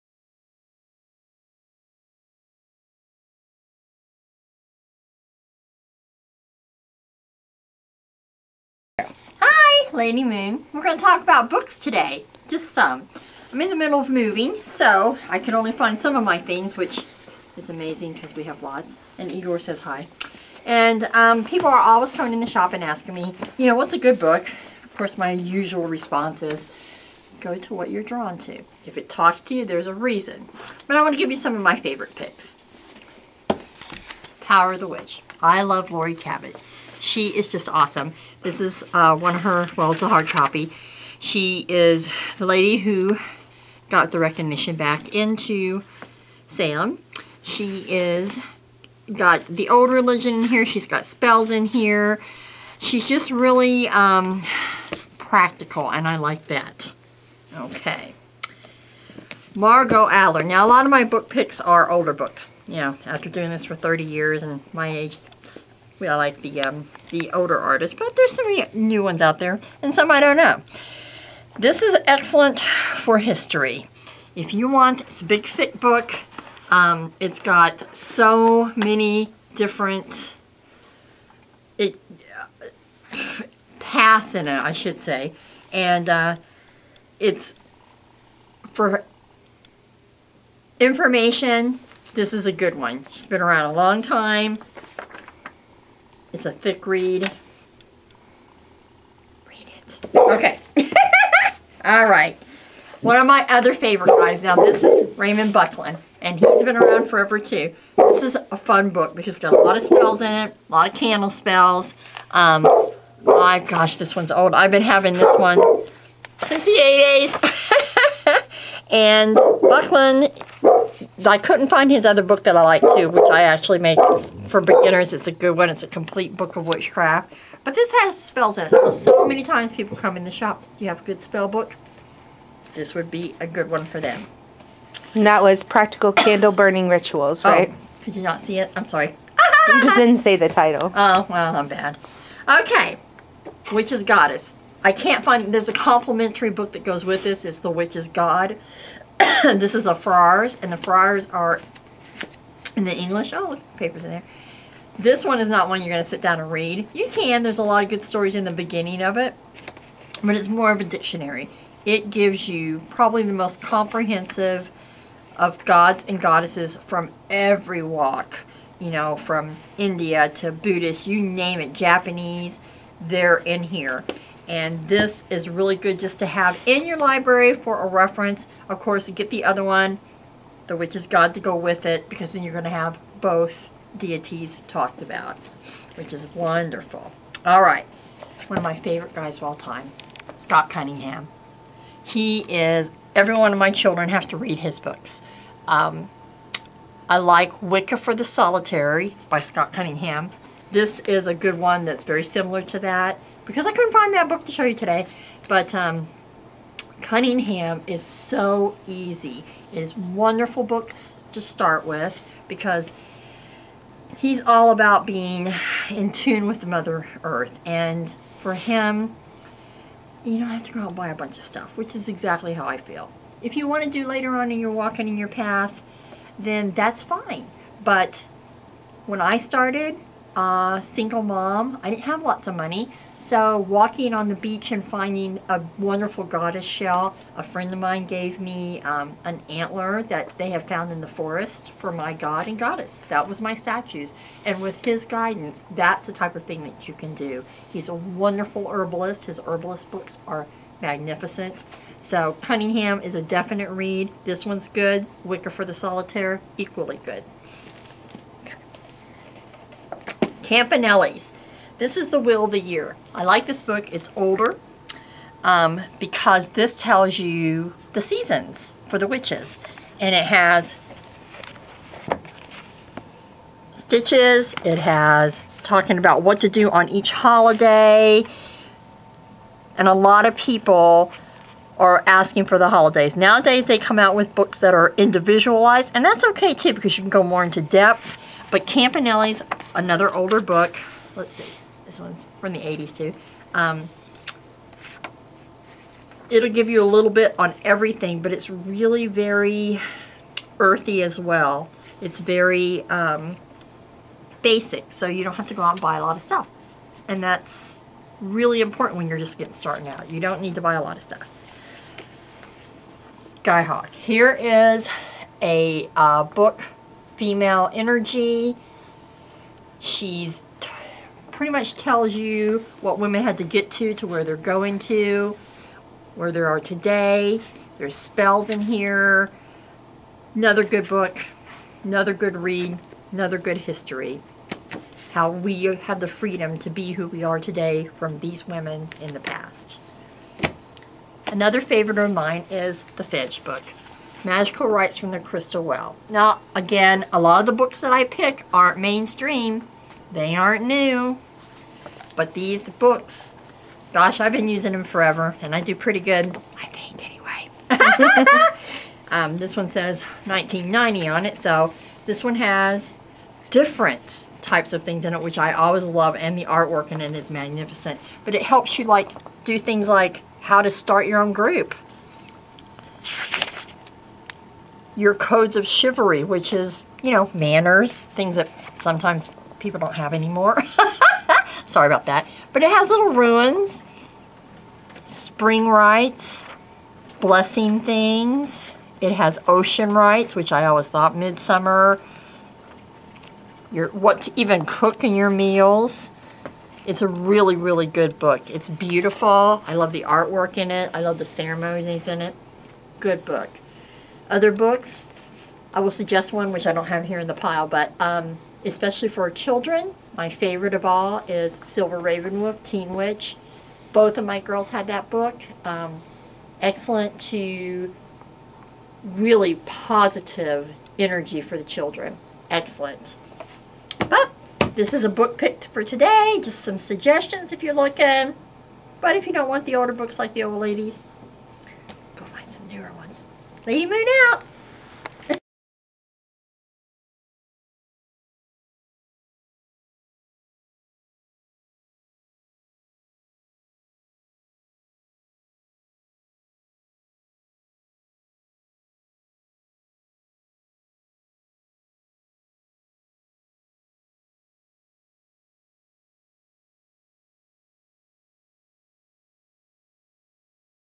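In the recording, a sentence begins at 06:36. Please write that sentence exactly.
It's a really, really good book.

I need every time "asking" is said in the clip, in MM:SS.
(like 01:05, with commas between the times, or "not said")
00:22, 04:42.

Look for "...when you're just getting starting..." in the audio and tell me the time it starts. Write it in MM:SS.
05:08.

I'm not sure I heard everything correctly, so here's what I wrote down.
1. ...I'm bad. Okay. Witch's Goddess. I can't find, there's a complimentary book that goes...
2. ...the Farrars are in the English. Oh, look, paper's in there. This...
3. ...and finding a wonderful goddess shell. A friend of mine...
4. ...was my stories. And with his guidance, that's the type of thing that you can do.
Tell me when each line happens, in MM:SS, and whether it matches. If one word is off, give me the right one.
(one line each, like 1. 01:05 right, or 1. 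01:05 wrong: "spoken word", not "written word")
1. 02:21 right
2. 02:30 right
3. 03:54 right
4. 04:03 wrong: "statues", not "stories".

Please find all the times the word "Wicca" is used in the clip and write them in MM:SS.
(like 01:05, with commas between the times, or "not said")
03:17, 04:15.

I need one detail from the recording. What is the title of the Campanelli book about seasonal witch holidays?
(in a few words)
The Wheel of the Year.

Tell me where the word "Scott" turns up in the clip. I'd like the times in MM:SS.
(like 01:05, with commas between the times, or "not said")
03:10, 03:19.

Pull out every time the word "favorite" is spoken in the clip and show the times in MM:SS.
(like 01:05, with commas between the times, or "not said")
00:31, 01:43, 03:08, 05:41, 06:50.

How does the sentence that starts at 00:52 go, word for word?
She's just really um, practical, and I like that.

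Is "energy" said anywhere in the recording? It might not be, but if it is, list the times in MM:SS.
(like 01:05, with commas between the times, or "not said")
05:17, 07:00.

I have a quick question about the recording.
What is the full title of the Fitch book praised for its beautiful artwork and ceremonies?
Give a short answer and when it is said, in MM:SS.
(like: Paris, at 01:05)
Magical Rites from the Crystal Well, at 05:44.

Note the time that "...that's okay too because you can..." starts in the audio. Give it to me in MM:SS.
04:46.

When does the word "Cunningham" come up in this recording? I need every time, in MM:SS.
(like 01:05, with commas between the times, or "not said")
03:10, 03:19, 03:27, 04:12.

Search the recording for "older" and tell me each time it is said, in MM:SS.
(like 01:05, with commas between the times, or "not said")
01:01, 01:07, 04:24, 04:50, 07:09.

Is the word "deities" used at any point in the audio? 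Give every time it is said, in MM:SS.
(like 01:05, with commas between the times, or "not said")
03:03.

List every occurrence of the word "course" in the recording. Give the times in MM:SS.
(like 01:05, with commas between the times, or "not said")
00:24, 02:58.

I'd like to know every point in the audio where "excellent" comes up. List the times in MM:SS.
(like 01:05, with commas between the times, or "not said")
01:12, 06:56, 07:02.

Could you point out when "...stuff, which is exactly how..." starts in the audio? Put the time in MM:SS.
03:41.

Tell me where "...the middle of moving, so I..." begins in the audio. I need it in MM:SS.
00:13.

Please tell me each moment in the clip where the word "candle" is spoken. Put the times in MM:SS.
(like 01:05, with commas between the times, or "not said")
01:50, 02:16.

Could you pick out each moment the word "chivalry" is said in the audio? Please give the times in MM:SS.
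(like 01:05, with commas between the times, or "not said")
06:15.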